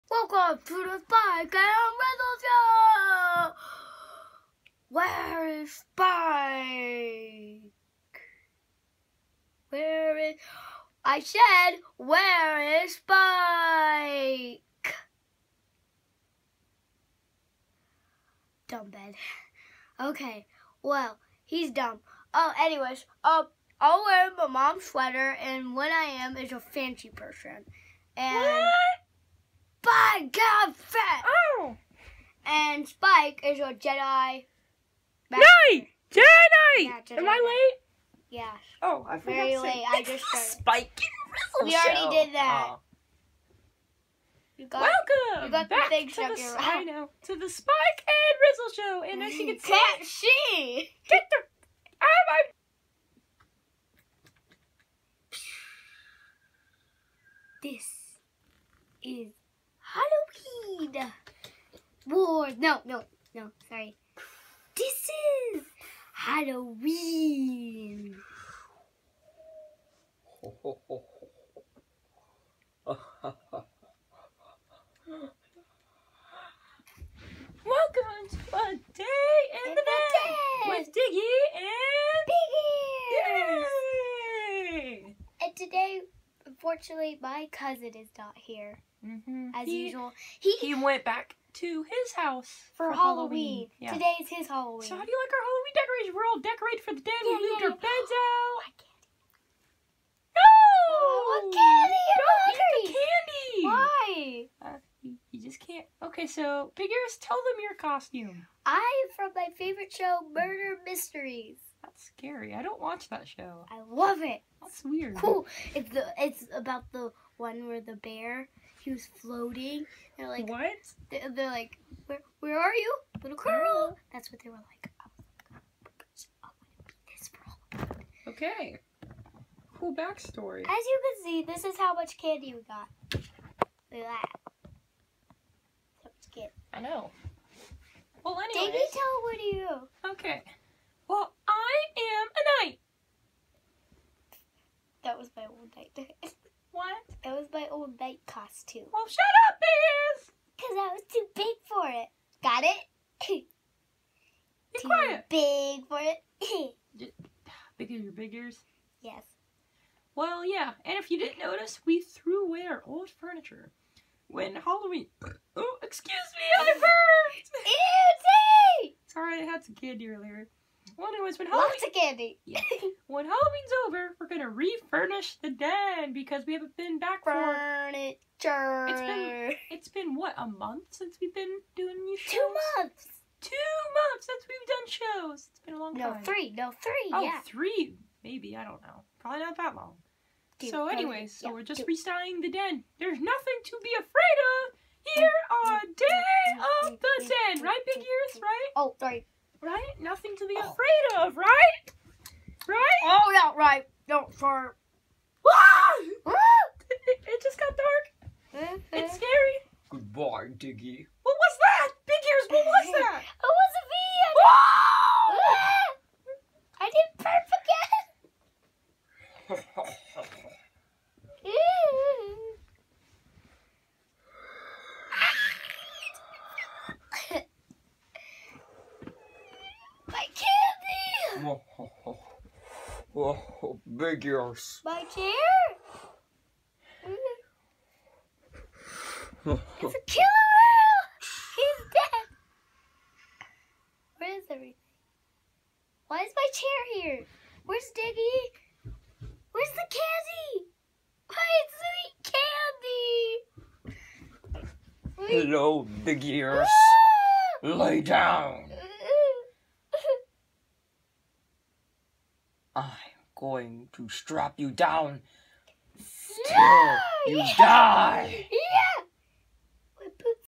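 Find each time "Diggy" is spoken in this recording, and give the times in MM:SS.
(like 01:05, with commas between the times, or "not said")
01:20, 03:30, 04:07.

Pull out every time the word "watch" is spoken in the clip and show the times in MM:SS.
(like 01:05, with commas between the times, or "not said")
01:52.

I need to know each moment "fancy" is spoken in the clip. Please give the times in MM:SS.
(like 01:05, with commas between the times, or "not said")
00:26.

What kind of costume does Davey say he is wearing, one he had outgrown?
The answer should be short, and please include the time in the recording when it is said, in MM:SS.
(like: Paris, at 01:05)
A knight, at 02:22.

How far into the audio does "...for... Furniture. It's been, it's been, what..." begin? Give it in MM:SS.
02:57.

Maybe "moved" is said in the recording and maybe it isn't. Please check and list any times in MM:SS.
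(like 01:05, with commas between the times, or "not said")
01:37.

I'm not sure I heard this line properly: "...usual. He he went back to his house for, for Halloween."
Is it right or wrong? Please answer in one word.
right.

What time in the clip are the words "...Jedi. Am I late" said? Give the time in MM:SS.
00:37.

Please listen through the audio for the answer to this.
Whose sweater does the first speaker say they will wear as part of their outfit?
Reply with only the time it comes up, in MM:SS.
00:24.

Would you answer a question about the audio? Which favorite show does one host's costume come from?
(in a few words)
Murder Mysteries.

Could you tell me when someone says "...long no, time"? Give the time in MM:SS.
03:05.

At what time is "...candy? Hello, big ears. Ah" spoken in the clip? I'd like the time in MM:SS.
04:15.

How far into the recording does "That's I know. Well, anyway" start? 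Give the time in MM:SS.
02:16.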